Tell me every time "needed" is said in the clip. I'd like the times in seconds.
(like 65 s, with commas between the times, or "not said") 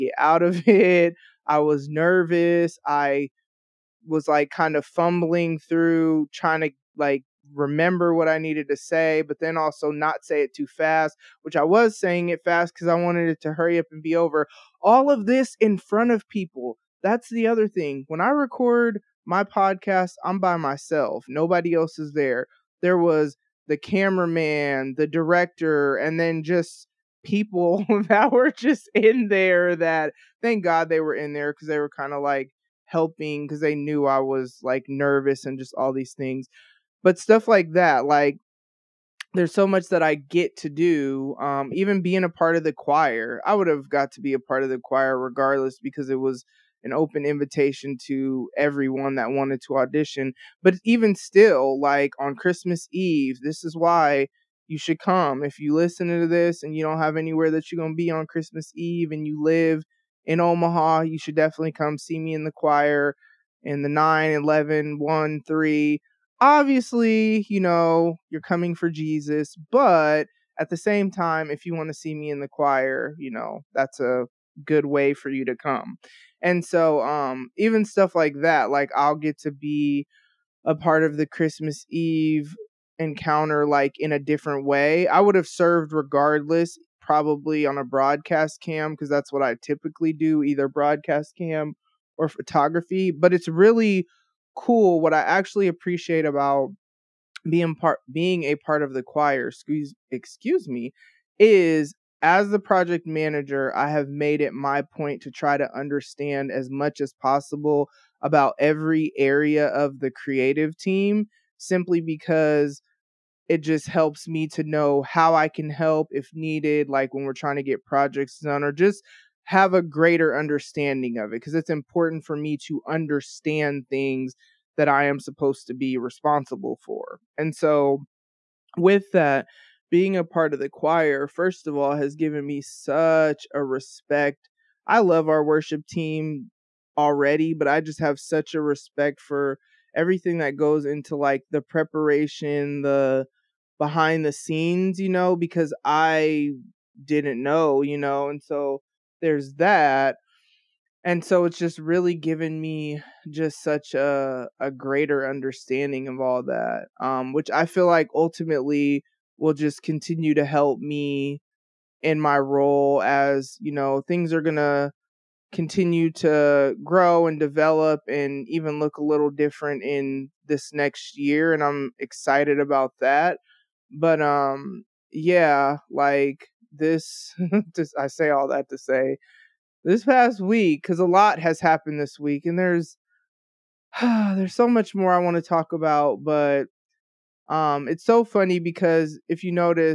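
8 s, 116 s.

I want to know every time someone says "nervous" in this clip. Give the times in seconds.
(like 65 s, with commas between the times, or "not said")
1 s, 34 s.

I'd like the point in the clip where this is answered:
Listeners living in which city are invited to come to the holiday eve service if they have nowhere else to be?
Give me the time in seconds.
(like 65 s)
60 s.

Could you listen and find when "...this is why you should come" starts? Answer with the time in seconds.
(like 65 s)
53 s.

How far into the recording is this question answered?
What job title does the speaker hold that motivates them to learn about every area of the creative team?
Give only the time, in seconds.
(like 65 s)
102 s.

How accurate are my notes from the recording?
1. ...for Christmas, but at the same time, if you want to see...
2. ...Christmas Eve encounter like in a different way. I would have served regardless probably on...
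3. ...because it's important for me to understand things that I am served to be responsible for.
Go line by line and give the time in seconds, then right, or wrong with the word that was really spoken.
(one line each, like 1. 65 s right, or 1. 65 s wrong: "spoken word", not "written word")
1. 68 s wrong: "Jesus", not "Christmas"
2. 81 s right
3. 121 s wrong: "supposed", not "served".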